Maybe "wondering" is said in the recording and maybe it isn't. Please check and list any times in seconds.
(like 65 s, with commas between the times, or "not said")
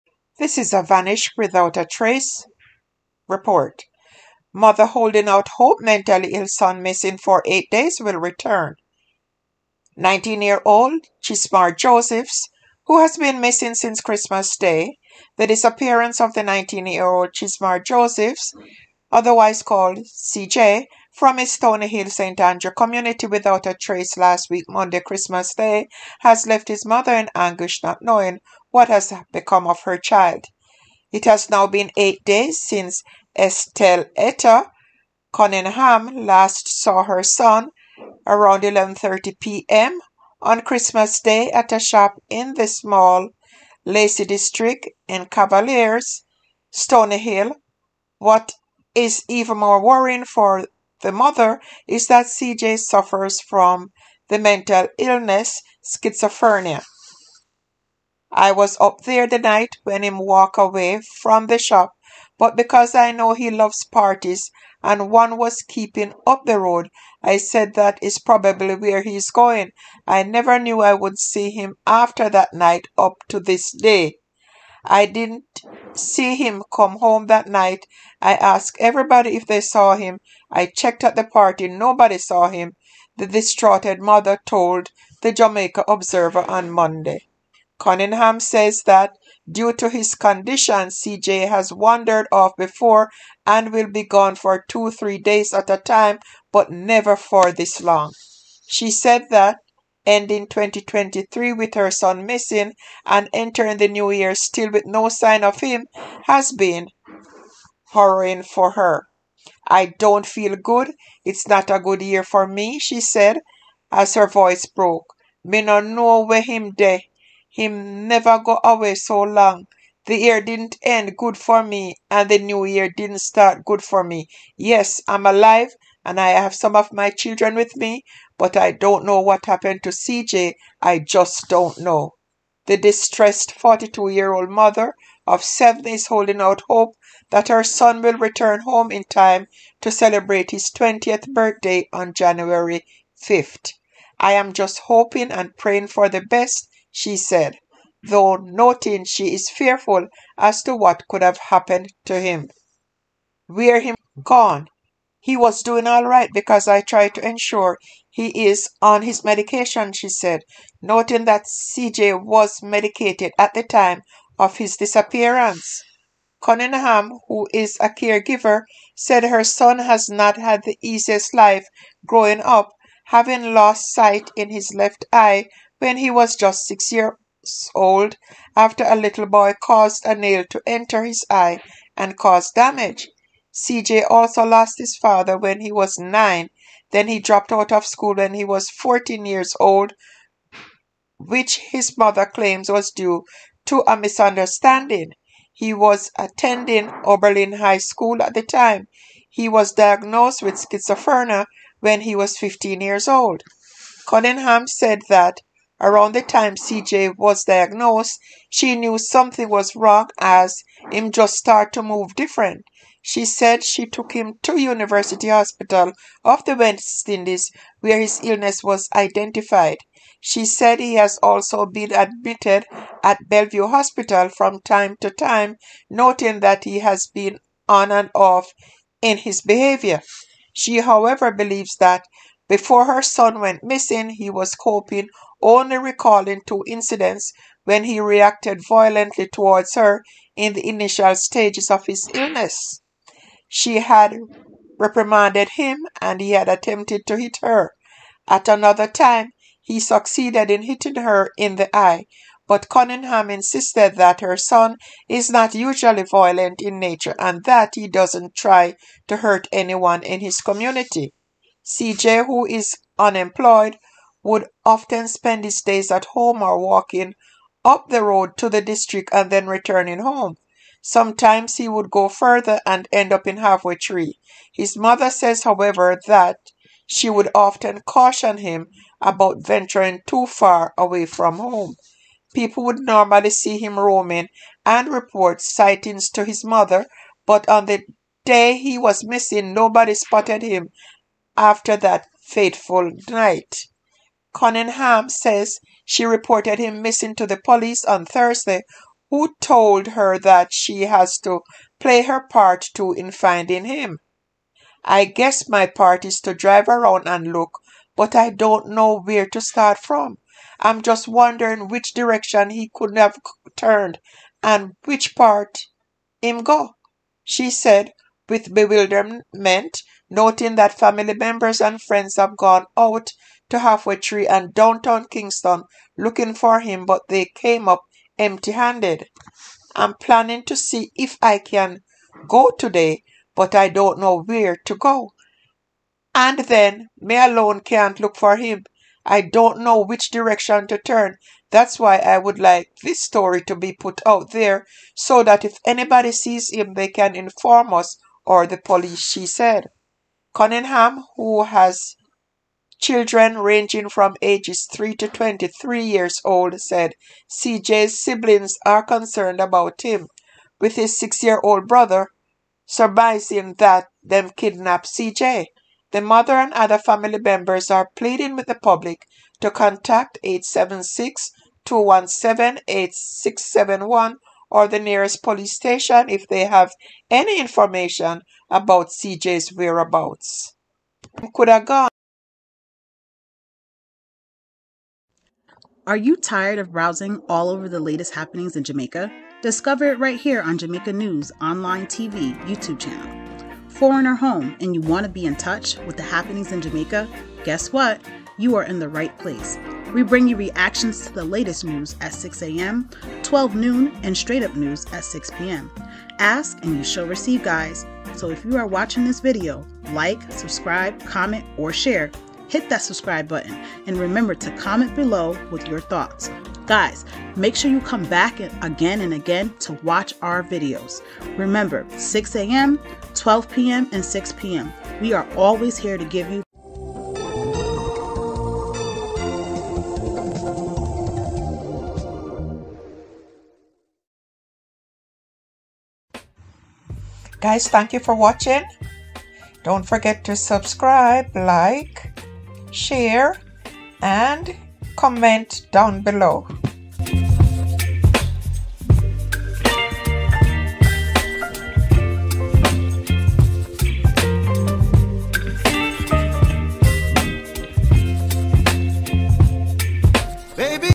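311 s.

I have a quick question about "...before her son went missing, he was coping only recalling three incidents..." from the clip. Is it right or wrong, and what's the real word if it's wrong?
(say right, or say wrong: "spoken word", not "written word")
wrong: "two", not "three".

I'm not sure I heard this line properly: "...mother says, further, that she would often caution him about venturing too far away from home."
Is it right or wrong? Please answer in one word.
wrong.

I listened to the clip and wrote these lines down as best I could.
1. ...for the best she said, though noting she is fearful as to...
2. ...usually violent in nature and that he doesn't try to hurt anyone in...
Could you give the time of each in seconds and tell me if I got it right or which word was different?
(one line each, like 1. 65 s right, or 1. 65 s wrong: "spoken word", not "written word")
1. 145 s right
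2. 255 s right.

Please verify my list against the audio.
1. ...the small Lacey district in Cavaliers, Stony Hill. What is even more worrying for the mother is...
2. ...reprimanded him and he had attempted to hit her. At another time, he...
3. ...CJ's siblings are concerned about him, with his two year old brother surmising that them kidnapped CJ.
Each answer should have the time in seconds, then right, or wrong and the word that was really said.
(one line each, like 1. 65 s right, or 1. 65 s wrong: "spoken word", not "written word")
1. 42 s right
2. 244 s right
3. 357 s wrong: "six", not "two".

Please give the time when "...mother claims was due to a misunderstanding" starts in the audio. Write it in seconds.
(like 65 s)
191 s.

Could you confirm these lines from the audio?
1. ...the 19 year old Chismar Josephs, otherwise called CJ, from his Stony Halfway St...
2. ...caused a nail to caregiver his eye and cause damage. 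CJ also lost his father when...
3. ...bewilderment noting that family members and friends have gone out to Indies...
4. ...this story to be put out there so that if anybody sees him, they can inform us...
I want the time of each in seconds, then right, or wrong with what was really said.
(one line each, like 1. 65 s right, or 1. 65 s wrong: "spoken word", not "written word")
1. 16 s wrong: "Hill", not "Halfway"
2. 179 s wrong: "enter", not "caregiver"
3. 318 s wrong: "Halfway", not "Indies"
4. 342 s right.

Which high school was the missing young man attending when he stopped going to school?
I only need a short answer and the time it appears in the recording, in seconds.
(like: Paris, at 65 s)
Oberlin High School, at 197 s.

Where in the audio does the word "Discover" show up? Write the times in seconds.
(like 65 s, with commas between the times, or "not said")
389 s.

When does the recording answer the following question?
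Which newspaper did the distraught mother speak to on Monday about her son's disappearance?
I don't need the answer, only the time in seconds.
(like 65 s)
85 s.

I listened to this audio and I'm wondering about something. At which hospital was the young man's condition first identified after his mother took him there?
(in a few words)
University Hospital of the West Indies.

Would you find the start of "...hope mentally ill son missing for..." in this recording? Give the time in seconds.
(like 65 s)
5 s.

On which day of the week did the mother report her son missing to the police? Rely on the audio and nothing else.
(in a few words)
Thursday.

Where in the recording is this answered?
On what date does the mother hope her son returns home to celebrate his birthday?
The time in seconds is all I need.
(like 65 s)
142 s.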